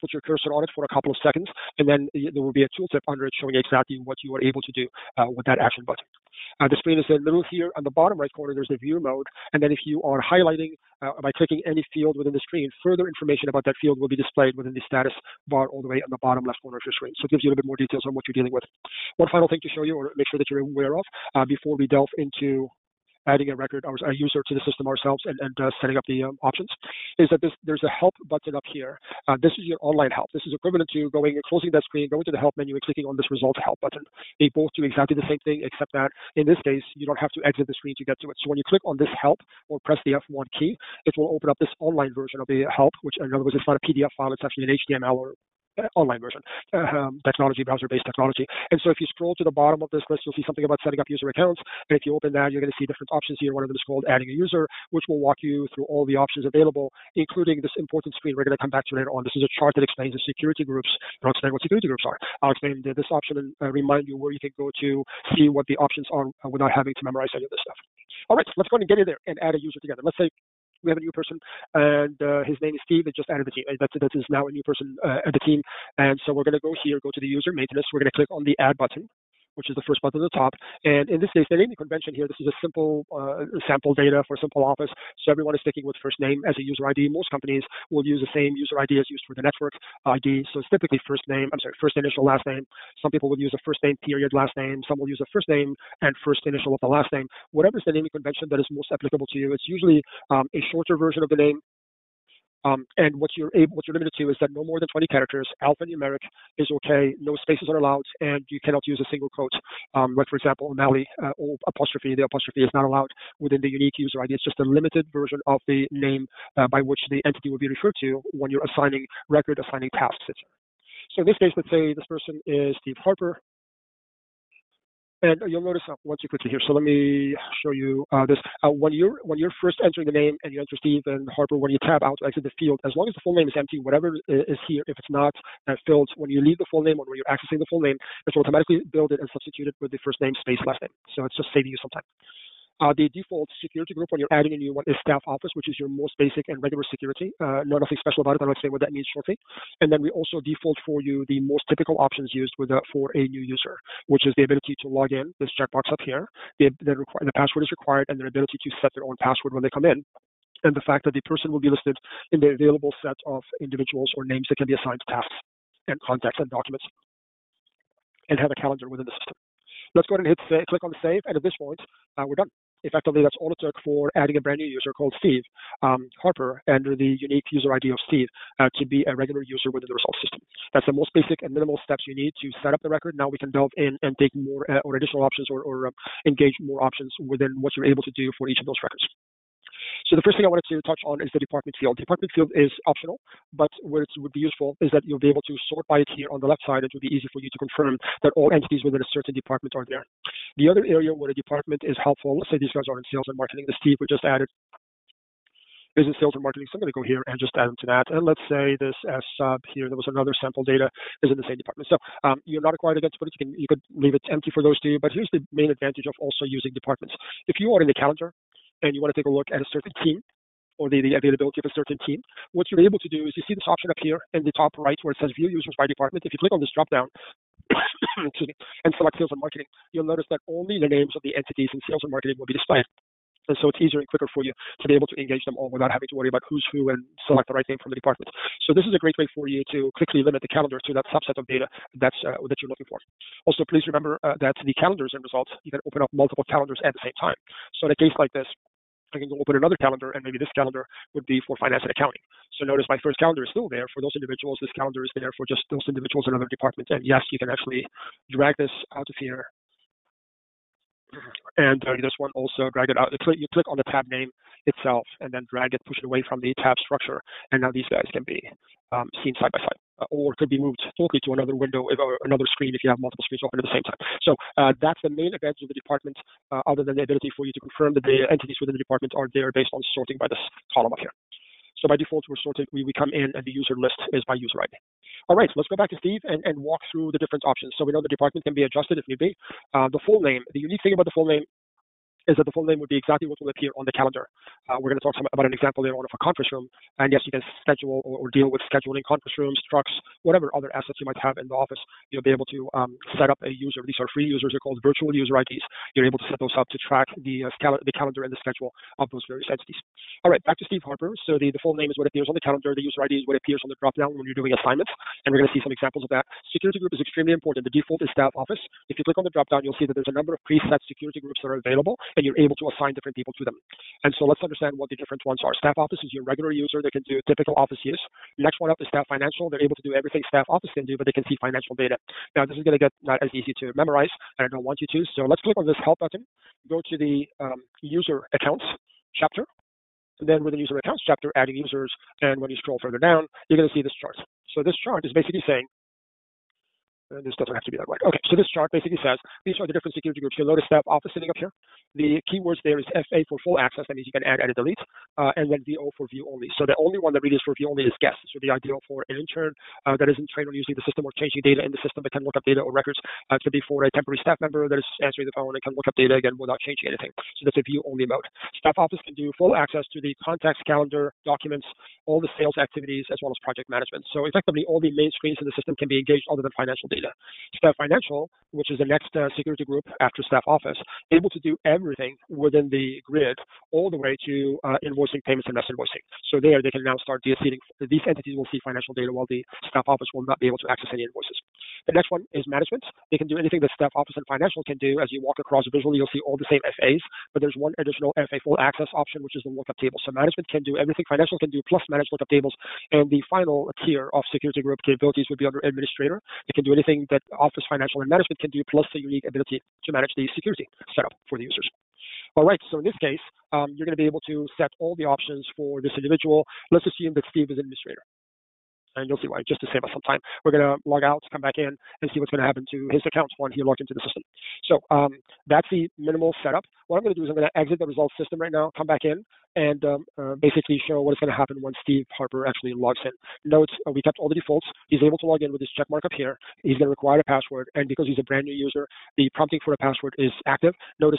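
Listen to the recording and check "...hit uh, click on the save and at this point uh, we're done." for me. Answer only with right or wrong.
right.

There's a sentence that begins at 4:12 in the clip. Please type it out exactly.
So notice my first calendar is still there for those individuals.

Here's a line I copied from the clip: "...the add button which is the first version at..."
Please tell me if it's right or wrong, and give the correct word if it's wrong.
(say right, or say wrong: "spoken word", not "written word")
wrong: "button", not "version".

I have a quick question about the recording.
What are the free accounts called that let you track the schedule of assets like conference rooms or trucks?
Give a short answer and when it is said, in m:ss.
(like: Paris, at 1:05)
Virtual user IDs, at 5:04.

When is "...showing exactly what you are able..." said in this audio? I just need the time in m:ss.
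0:03.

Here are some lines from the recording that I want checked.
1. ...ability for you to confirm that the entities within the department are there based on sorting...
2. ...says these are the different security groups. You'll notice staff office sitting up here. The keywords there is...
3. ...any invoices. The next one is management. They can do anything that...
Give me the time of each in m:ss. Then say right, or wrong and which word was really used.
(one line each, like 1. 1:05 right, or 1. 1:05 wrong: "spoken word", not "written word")
1. 4:37 right
2. 5:49 right
3. 6:30 right.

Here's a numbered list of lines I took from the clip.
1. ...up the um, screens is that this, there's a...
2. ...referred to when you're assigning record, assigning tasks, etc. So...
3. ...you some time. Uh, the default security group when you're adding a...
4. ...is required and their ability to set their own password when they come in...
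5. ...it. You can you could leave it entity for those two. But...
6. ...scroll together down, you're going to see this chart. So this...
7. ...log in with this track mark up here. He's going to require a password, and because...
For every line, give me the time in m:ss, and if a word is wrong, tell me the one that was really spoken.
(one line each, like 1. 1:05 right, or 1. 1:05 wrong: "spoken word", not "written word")
1. 0:25 wrong: "options", not "screens"
2. 1:57 right
3. 2:21 right
4. 2:37 right
5. 3:33 wrong: "empty", not "entity"
6. 5:42 wrong: "further", not "together"
7. 7:15 wrong: "check", not "track".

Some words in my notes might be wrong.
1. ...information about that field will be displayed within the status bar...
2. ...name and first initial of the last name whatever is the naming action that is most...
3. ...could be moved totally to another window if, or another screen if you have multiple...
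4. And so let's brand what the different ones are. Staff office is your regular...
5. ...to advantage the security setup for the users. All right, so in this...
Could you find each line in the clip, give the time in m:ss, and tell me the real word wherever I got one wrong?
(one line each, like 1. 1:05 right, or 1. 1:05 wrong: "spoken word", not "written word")
1. 0:13 right
2. 1:35 wrong: "convention", not "action"
3. 4:30 right
4. 5:24 wrong: "understand", not "brand"
5. 6:49 wrong: "manage", not "advantage".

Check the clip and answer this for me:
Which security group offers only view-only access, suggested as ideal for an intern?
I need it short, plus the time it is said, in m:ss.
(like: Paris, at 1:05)
Guest, at 5:58.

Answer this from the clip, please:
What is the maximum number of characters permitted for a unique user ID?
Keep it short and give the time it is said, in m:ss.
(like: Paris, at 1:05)
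20, at 1:44.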